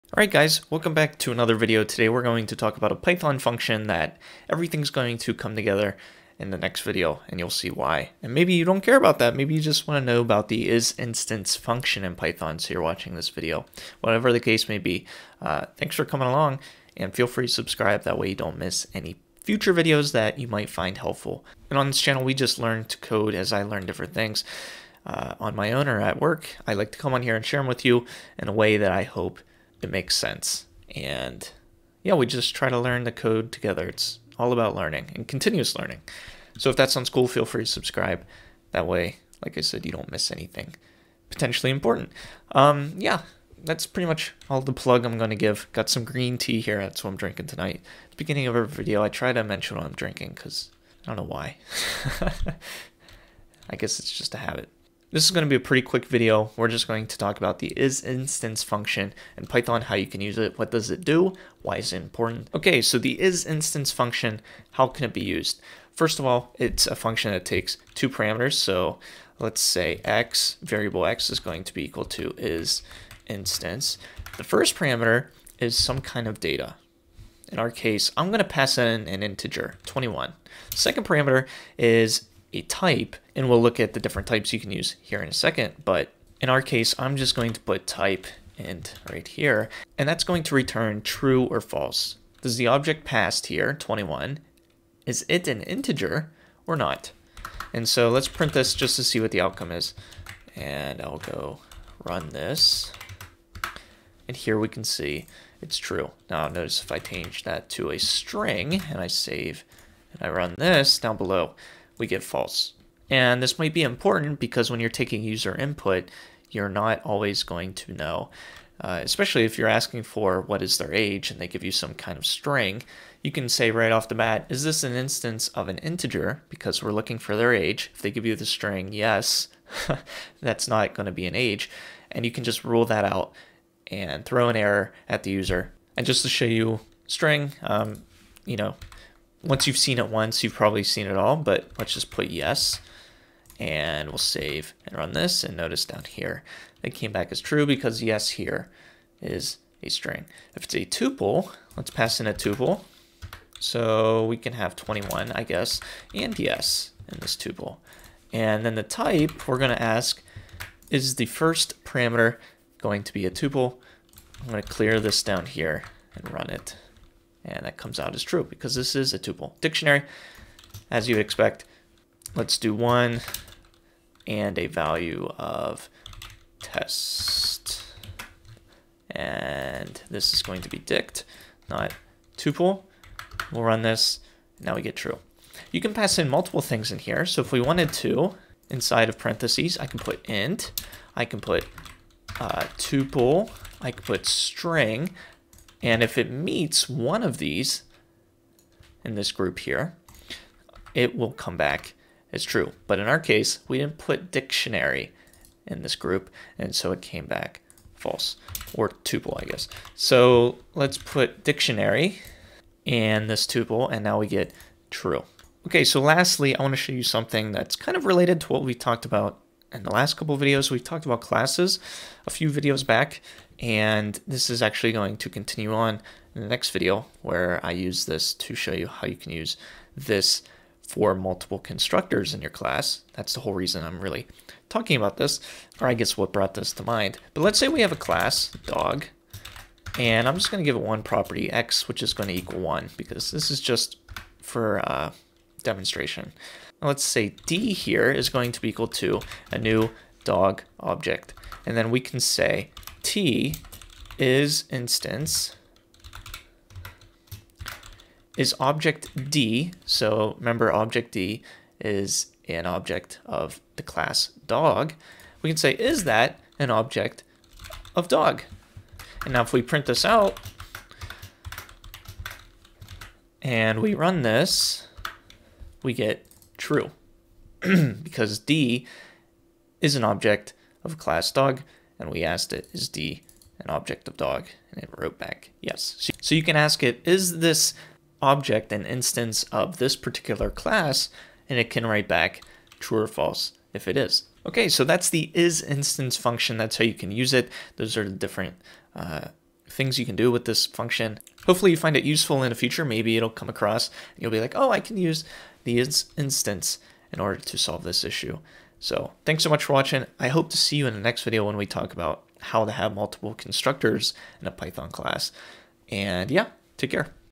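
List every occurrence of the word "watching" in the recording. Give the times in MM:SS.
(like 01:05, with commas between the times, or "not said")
00:12, 05:09.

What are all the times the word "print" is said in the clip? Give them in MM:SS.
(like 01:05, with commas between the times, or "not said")
01:38, 04:29.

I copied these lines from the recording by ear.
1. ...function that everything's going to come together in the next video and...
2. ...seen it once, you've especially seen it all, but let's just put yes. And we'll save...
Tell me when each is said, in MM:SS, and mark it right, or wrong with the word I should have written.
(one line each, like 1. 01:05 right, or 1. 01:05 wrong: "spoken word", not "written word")
1. 00:03 right
2. 02:19 wrong: "probably", not "especially".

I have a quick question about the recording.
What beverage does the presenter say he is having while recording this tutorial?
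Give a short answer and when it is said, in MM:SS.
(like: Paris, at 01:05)
Green tea, at 00:46.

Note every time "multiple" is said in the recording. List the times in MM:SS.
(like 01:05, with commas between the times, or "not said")
03:06, 03:51, 05:12.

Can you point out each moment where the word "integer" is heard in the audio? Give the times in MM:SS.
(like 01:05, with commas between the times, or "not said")
01:19, 01:35, 02:05.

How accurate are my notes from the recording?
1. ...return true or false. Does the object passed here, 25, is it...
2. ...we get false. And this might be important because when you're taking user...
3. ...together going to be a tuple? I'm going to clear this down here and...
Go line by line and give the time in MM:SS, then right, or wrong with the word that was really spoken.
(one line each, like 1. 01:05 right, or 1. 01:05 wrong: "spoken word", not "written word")
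1. 01:30 wrong: "21", not "25"
2. 01:52 right
3. 02:41 wrong: "parameter", not "together".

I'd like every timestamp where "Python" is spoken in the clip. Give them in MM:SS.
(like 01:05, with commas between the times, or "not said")
00:02, 00:12, 00:59, 05:14.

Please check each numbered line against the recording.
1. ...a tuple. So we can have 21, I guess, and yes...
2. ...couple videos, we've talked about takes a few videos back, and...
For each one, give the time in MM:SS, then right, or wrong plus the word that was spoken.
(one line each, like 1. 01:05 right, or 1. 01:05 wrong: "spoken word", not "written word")
1. 02:32 right
2. 03:40 wrong: "classes", not "takes".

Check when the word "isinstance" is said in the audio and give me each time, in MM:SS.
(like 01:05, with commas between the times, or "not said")
00:10, 00:57, 01:03.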